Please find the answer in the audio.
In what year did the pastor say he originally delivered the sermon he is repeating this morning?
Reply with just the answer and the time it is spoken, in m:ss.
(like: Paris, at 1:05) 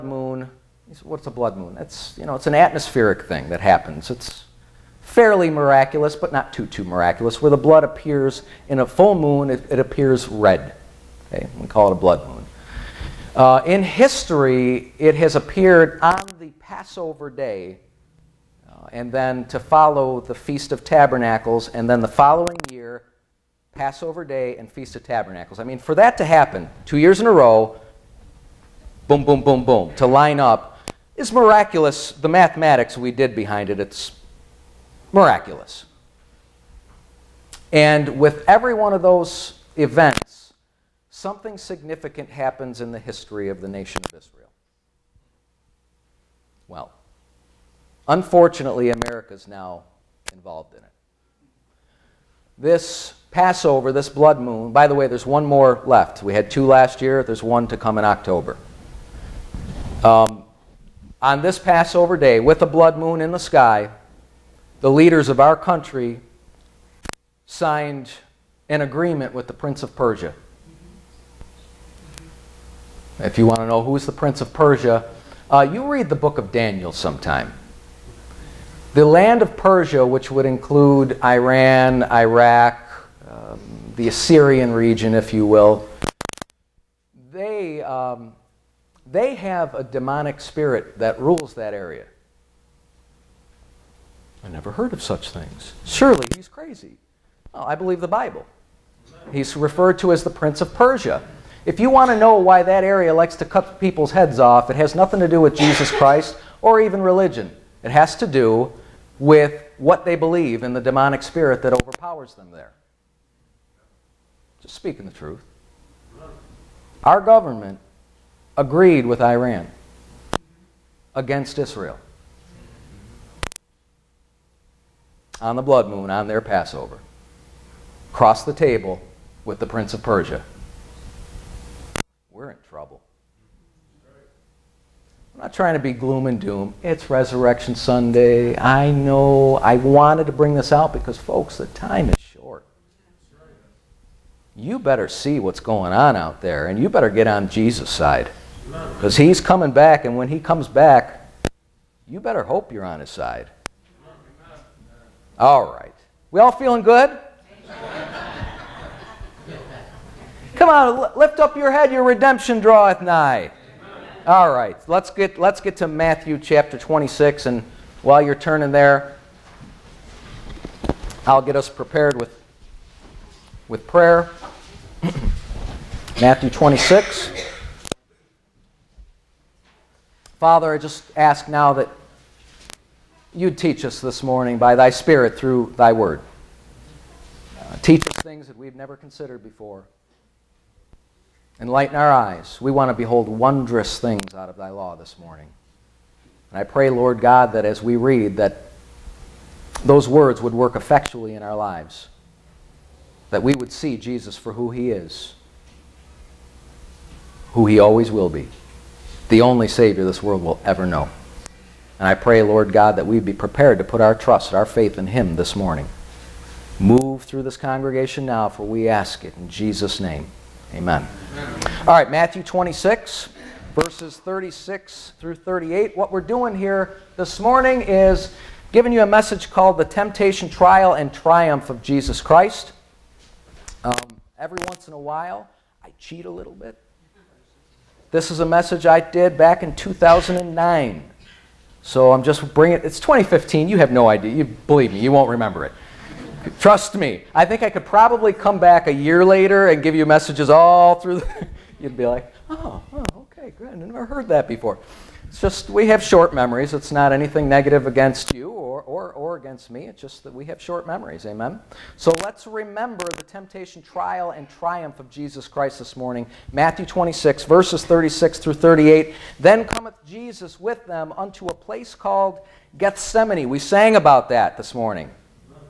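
2009, at 3:59.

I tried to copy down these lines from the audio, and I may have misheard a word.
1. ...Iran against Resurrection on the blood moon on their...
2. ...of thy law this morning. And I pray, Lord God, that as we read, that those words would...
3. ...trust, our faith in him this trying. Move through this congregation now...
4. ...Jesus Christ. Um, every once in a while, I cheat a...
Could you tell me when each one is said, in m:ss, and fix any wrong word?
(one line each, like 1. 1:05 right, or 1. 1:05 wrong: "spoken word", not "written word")
1. 1:59 wrong: "Israel", not "Resurrection"
2. 3:14 right
3. 3:34 wrong: "morning", not "trying"
4. 3:51 right.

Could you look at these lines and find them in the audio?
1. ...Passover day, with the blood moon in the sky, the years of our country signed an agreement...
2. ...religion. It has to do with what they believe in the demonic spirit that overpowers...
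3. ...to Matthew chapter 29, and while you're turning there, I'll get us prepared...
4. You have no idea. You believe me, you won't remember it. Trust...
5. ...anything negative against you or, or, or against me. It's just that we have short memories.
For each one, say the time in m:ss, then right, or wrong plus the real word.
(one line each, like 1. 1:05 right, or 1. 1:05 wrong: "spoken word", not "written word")
1. 1:01 wrong: "leaders", not "years"
2. 1:47 right
3. 2:45 wrong: "26", not "29"
4. 4:03 right
5. 4:17 right.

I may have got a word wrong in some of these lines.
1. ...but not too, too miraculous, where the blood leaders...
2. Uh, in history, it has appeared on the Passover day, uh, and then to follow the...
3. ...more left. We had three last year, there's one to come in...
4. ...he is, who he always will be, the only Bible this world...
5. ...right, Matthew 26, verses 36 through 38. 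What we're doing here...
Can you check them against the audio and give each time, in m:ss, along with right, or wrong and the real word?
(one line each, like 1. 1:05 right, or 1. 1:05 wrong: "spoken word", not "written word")
1. 0:06 wrong: "appears", not "leaders"
2. 0:13 right
3. 0:55 wrong: "two", not "three"
4. 3:24 wrong: "Savior", not "Bible"
5. 3:41 right.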